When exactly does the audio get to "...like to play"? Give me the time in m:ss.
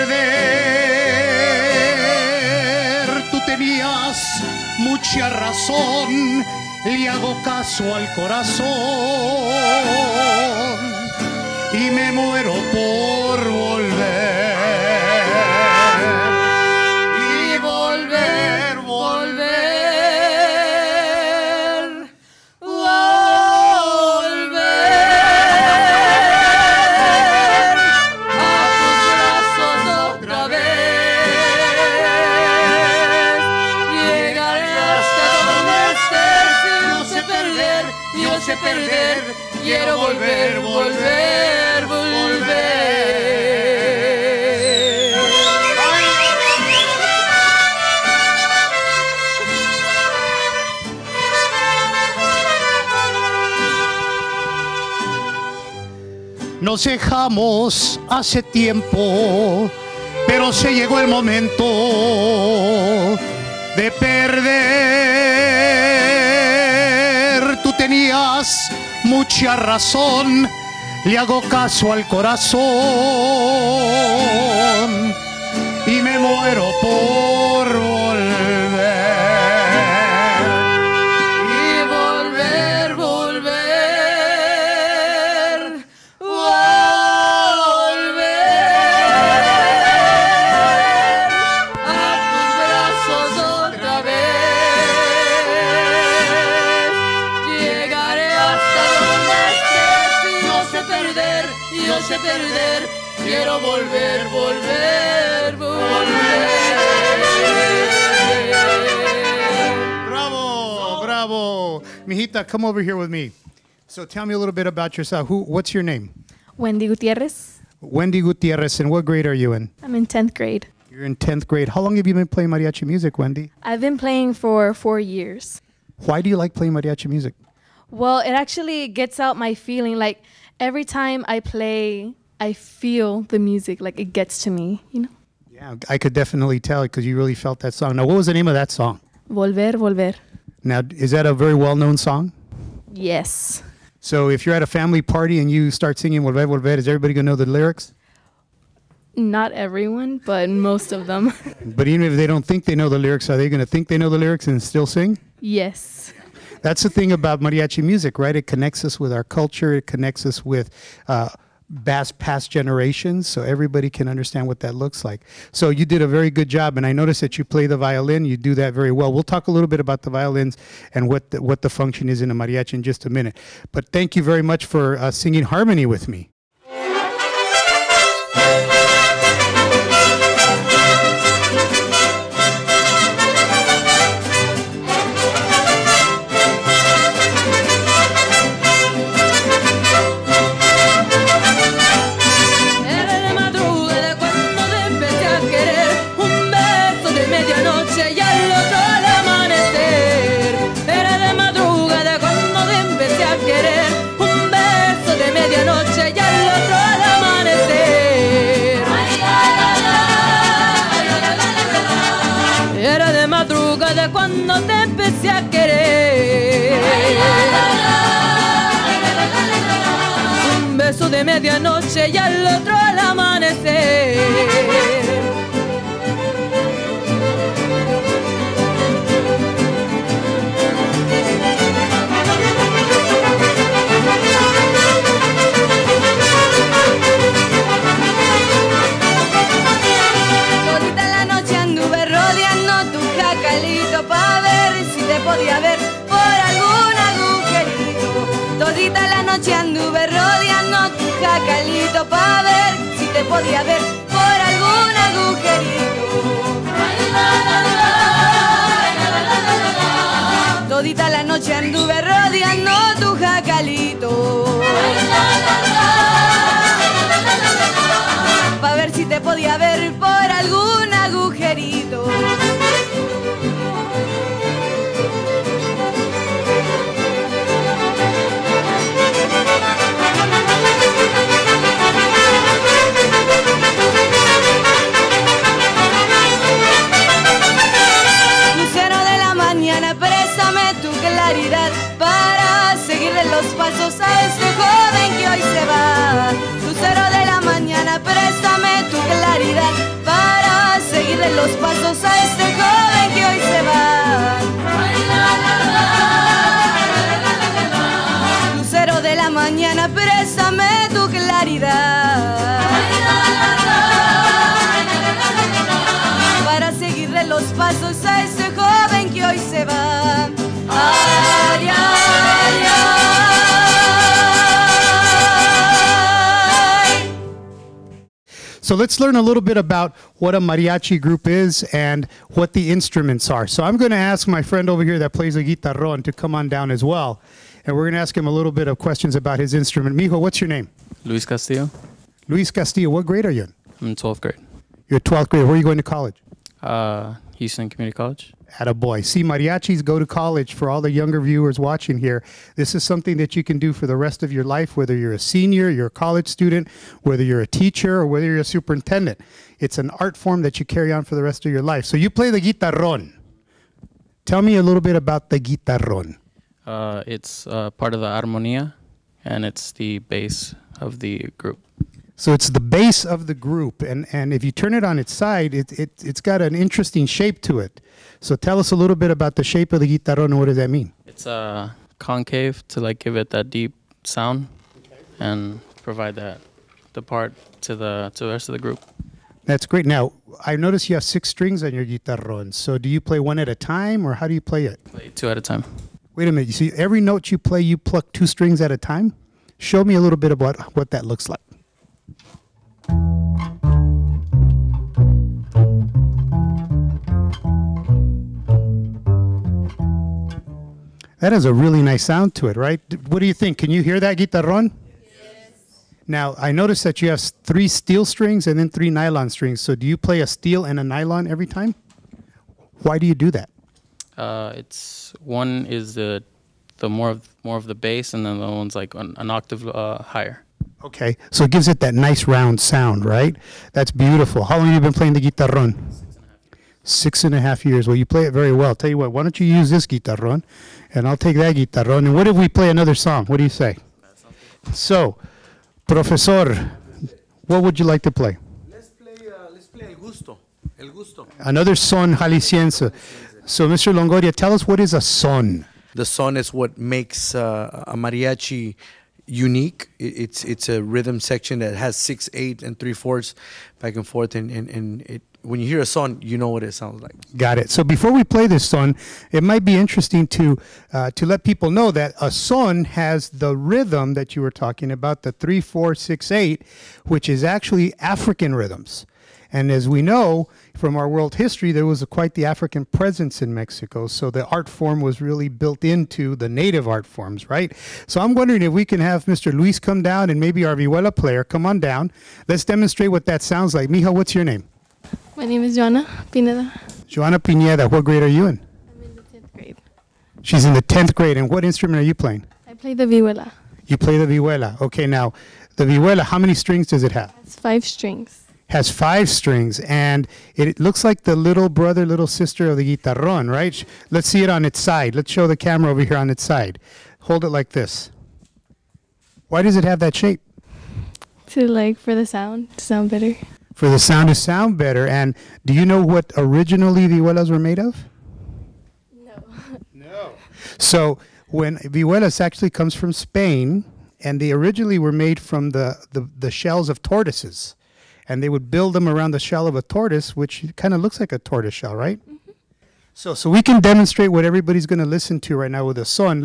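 7:27.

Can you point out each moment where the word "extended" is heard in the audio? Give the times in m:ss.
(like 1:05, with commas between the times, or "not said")
not said.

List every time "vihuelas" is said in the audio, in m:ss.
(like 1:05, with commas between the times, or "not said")
8:47, 8:51.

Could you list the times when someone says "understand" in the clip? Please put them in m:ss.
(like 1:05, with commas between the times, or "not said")
2:44.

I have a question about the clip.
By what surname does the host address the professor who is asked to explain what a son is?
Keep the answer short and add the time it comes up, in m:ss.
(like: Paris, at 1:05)
Longoria, at 7:33.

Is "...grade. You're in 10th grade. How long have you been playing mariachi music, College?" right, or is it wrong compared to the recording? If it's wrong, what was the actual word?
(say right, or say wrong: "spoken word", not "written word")
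wrong: "Wendy", not "College".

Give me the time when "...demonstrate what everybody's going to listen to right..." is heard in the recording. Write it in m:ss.
9:03.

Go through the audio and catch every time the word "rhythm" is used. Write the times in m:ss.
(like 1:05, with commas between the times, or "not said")
7:40, 7:53, 7:58.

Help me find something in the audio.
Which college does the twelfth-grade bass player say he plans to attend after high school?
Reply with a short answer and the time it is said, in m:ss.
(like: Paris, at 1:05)
Houston Community College, at 5:47.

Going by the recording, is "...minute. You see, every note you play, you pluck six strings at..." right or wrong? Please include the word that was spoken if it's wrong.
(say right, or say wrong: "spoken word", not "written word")
wrong: "two", not "six".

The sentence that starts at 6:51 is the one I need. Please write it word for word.
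That has a really nice sound to it, right?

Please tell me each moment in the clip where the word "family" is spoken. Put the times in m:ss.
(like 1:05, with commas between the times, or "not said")
2:24.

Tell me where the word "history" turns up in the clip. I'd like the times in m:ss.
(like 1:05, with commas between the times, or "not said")
8:01.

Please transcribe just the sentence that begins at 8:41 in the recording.
To like for the sound to sound better.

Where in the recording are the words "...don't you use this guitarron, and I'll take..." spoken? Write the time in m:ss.
7:19.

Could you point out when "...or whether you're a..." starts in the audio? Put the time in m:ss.
5:57.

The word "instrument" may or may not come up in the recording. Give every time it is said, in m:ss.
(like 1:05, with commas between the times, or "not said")
5:32, 5:39, 8:21.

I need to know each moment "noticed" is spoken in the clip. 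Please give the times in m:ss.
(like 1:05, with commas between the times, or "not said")
2:46, 6:30, 6:56.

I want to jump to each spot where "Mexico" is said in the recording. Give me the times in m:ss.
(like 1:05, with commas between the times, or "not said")
8:03.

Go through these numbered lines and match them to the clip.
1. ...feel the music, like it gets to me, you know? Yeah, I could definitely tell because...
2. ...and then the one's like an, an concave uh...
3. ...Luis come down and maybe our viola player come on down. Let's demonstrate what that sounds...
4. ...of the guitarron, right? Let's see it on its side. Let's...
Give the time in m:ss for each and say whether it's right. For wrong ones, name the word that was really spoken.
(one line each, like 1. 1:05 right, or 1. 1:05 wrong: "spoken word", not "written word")
1. 2:12 right
2. 7:08 wrong: "octave", not "concave"
3. 8:09 right
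4. 8:32 right.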